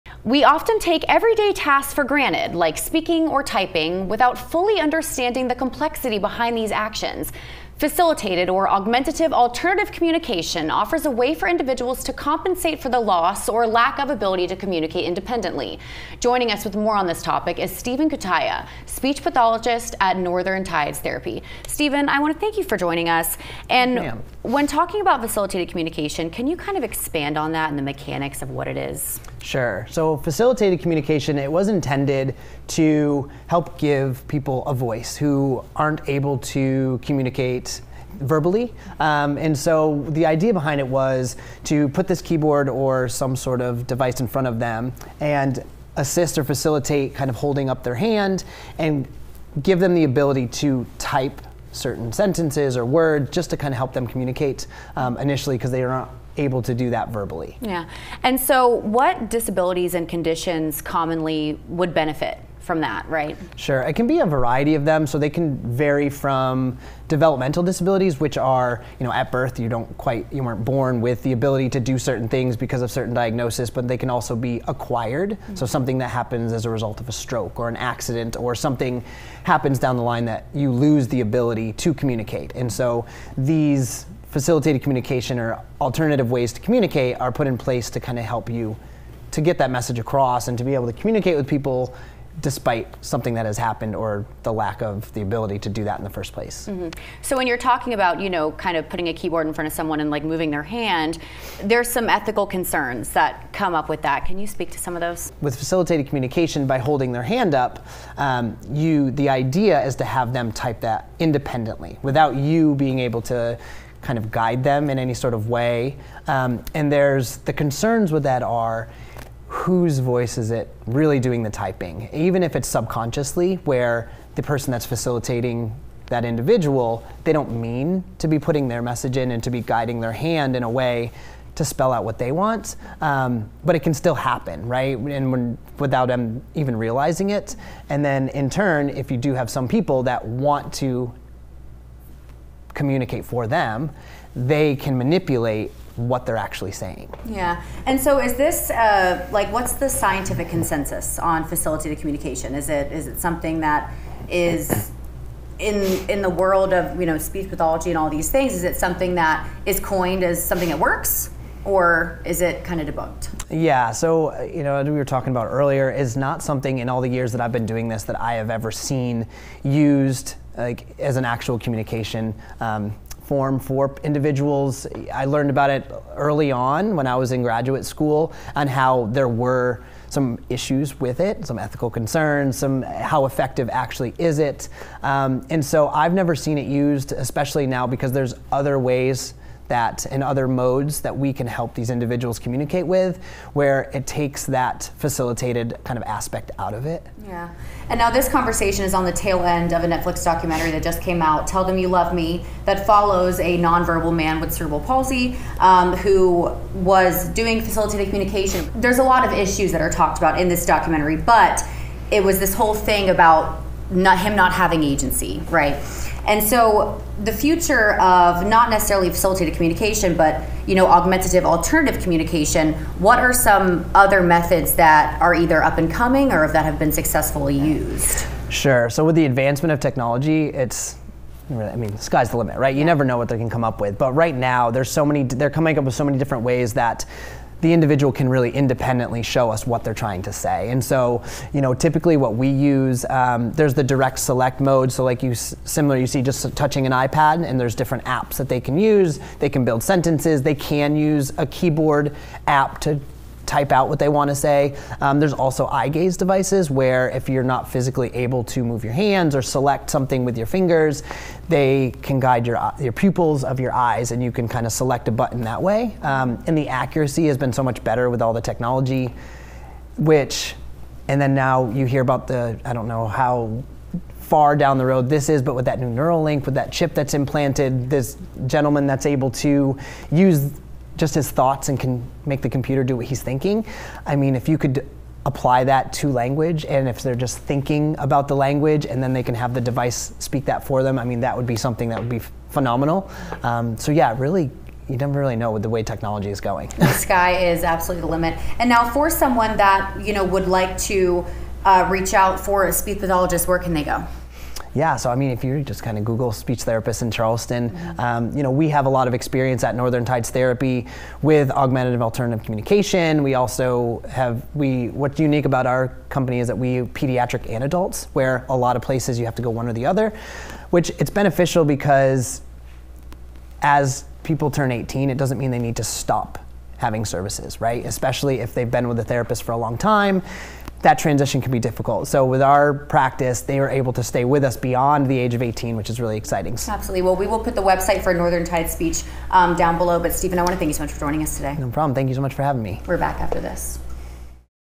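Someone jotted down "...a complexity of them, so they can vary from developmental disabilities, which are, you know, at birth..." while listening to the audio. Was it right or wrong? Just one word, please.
wrong.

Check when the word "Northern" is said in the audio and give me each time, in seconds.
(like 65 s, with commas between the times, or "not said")
20 s, 309 s, 338 s.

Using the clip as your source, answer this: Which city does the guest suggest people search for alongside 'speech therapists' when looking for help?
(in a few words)
Charleston.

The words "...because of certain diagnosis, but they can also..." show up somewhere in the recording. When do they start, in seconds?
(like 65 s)
72 s.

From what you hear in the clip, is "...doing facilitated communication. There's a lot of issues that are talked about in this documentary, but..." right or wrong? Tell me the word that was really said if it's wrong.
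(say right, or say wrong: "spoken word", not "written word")
right.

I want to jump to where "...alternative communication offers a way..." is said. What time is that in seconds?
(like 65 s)
9 s.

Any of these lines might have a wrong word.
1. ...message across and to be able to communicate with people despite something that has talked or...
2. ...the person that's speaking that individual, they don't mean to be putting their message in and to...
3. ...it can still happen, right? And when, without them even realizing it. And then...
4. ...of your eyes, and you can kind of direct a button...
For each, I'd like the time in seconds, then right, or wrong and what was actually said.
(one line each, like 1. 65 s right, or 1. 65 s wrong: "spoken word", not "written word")
1. 89 s wrong: "happened", not "talked"
2. 124 s wrong: "facilitating", not "speaking"
3. 133 s right
4. 263 s wrong: "select", not "direct".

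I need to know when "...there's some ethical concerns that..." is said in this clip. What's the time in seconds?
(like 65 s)
101 s.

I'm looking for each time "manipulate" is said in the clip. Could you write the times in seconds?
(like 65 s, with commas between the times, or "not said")
144 s.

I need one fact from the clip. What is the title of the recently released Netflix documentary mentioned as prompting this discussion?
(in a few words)
Tell Them You Love Me.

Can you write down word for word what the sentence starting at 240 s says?
And so, you know, typically what we use, um, there's the direct select mode.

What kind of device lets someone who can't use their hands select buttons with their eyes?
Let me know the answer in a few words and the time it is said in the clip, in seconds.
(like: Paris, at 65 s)
eye gaze devices, at 255 s.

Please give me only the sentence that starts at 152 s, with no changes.
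Is it is it something that is in in the world of you know speech pathology and all these things?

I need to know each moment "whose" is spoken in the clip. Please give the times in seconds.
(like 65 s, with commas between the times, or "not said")
119 s.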